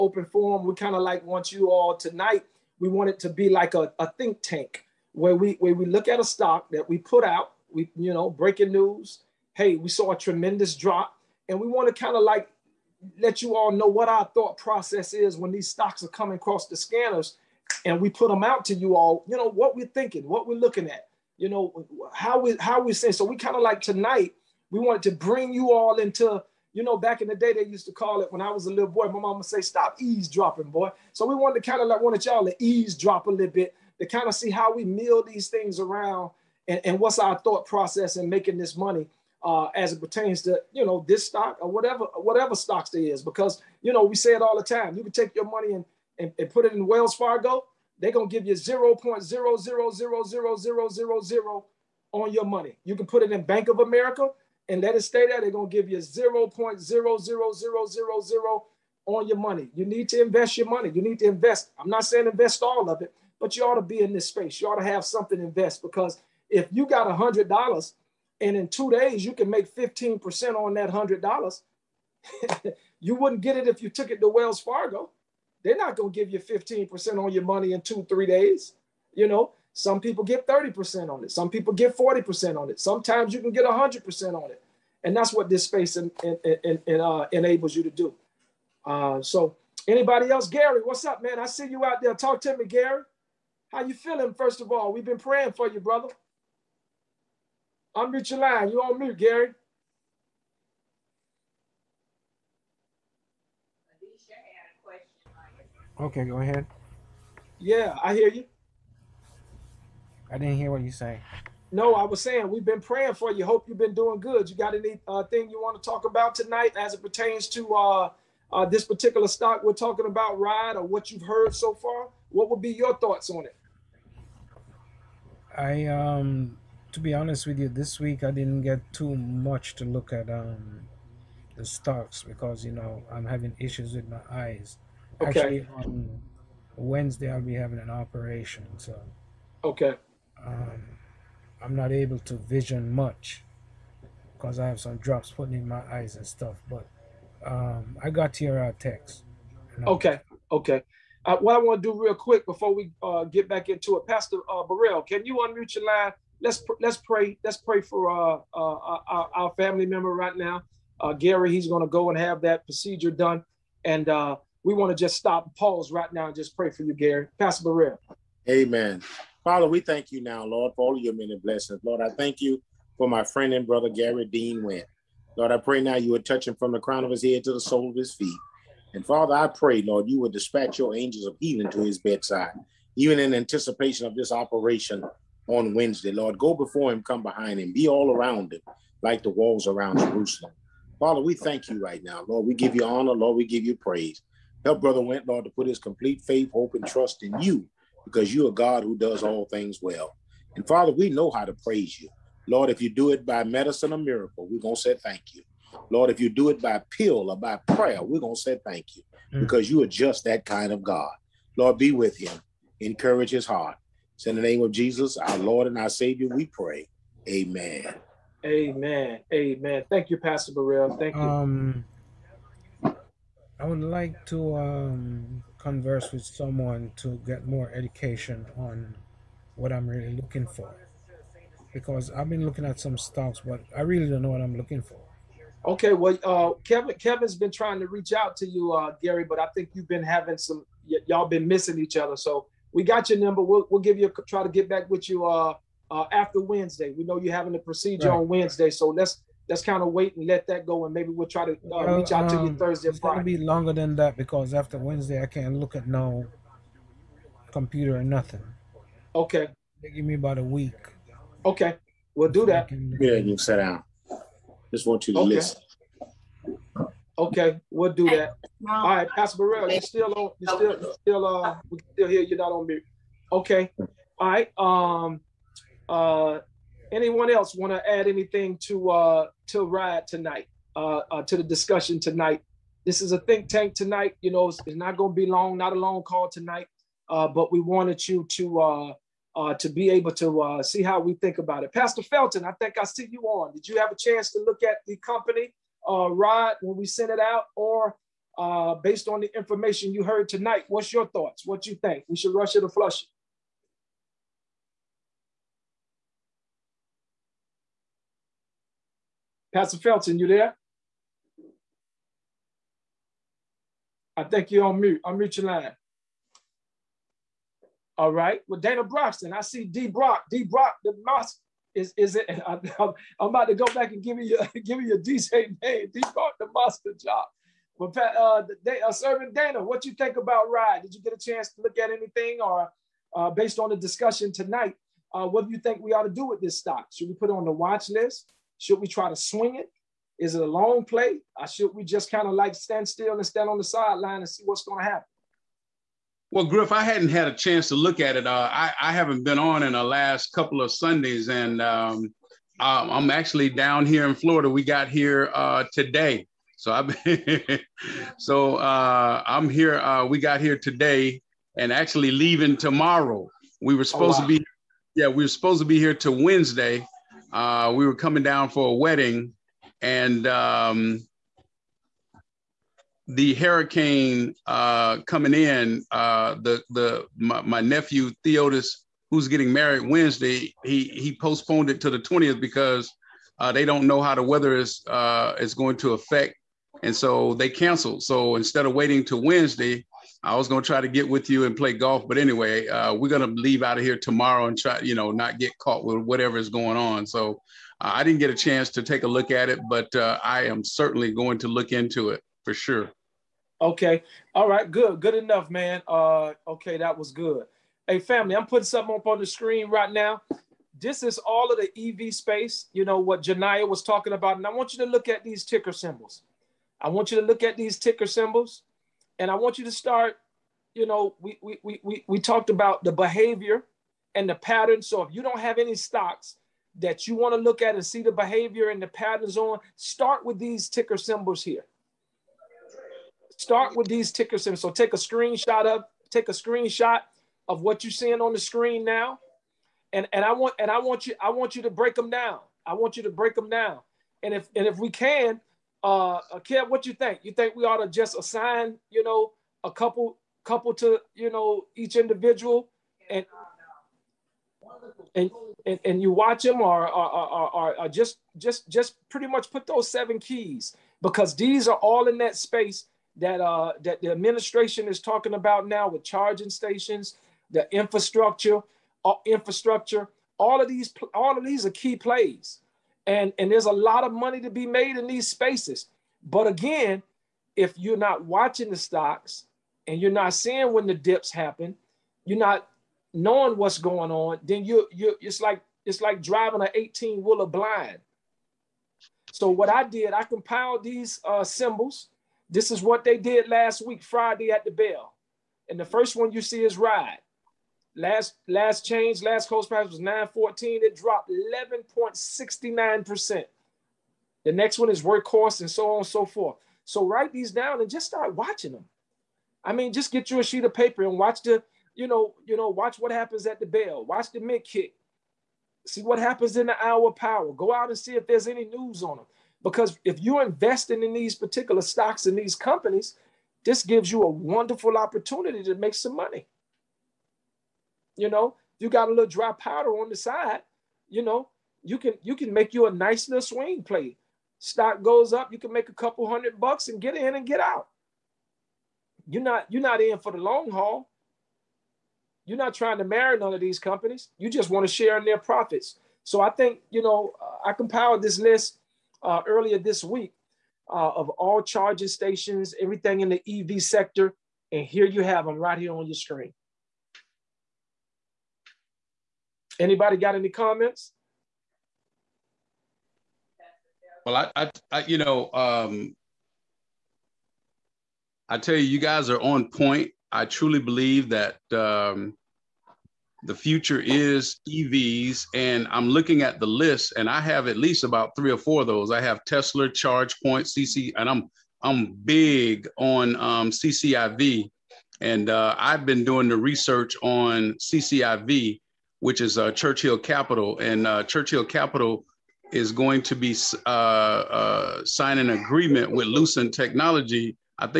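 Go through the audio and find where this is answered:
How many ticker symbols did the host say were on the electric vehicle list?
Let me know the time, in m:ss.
7:39.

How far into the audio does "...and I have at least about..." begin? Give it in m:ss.
9:37.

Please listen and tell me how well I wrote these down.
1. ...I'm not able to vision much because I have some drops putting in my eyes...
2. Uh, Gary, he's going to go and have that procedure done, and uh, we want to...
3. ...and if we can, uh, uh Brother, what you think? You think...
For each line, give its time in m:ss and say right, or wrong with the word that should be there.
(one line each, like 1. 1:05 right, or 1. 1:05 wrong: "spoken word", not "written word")
1. 2:21 right
2. 2:40 right
3. 7:24 wrong: "Kev", not "Brother".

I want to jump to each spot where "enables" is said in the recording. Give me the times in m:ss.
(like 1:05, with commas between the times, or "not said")
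1:27.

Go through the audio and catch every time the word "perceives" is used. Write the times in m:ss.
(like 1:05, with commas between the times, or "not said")
not said.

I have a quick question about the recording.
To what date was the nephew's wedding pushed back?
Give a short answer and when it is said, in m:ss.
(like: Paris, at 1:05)
the 20th, at 6:21.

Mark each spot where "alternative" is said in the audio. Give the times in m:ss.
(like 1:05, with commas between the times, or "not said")
not said.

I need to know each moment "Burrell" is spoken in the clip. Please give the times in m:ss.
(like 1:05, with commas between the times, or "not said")
2:34, 3:40, 4:29.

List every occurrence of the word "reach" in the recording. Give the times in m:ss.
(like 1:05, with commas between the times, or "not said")
3:57, 4:11.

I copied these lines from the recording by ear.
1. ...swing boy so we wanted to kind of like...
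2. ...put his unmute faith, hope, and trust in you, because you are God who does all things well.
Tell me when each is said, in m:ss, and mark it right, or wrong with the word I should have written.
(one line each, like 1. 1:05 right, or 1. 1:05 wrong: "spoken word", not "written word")
1. 0:29 wrong: "eavesdropping", not "swing"
2. 3:15 wrong: "complete", not "unmute".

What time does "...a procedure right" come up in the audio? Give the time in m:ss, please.
4:07.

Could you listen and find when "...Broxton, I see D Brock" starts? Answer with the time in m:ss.
5:18.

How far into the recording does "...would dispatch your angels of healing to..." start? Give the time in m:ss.
3:00.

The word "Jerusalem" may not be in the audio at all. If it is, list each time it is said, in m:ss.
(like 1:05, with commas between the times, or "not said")
3:09.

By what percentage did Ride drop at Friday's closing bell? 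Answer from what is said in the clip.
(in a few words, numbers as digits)
11.69%.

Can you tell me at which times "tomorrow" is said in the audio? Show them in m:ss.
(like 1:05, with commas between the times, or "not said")
6:02, 6:33.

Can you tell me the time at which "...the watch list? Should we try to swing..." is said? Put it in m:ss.
5:37.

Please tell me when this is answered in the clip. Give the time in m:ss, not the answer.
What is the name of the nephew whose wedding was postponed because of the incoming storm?
6:18.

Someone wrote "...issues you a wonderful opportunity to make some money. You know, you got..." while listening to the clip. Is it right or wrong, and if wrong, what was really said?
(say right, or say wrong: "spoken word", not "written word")
wrong: "gives", not "issues".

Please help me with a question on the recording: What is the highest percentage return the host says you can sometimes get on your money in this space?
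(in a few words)
100%.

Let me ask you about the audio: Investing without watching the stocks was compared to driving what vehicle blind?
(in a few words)
18 wheeler.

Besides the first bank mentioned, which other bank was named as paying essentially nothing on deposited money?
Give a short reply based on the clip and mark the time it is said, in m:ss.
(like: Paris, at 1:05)
Bank of America, at 0:53.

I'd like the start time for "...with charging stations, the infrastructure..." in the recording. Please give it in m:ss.
7:45.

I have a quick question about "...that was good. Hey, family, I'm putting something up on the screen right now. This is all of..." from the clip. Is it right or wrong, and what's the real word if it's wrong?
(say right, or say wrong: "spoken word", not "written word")
right.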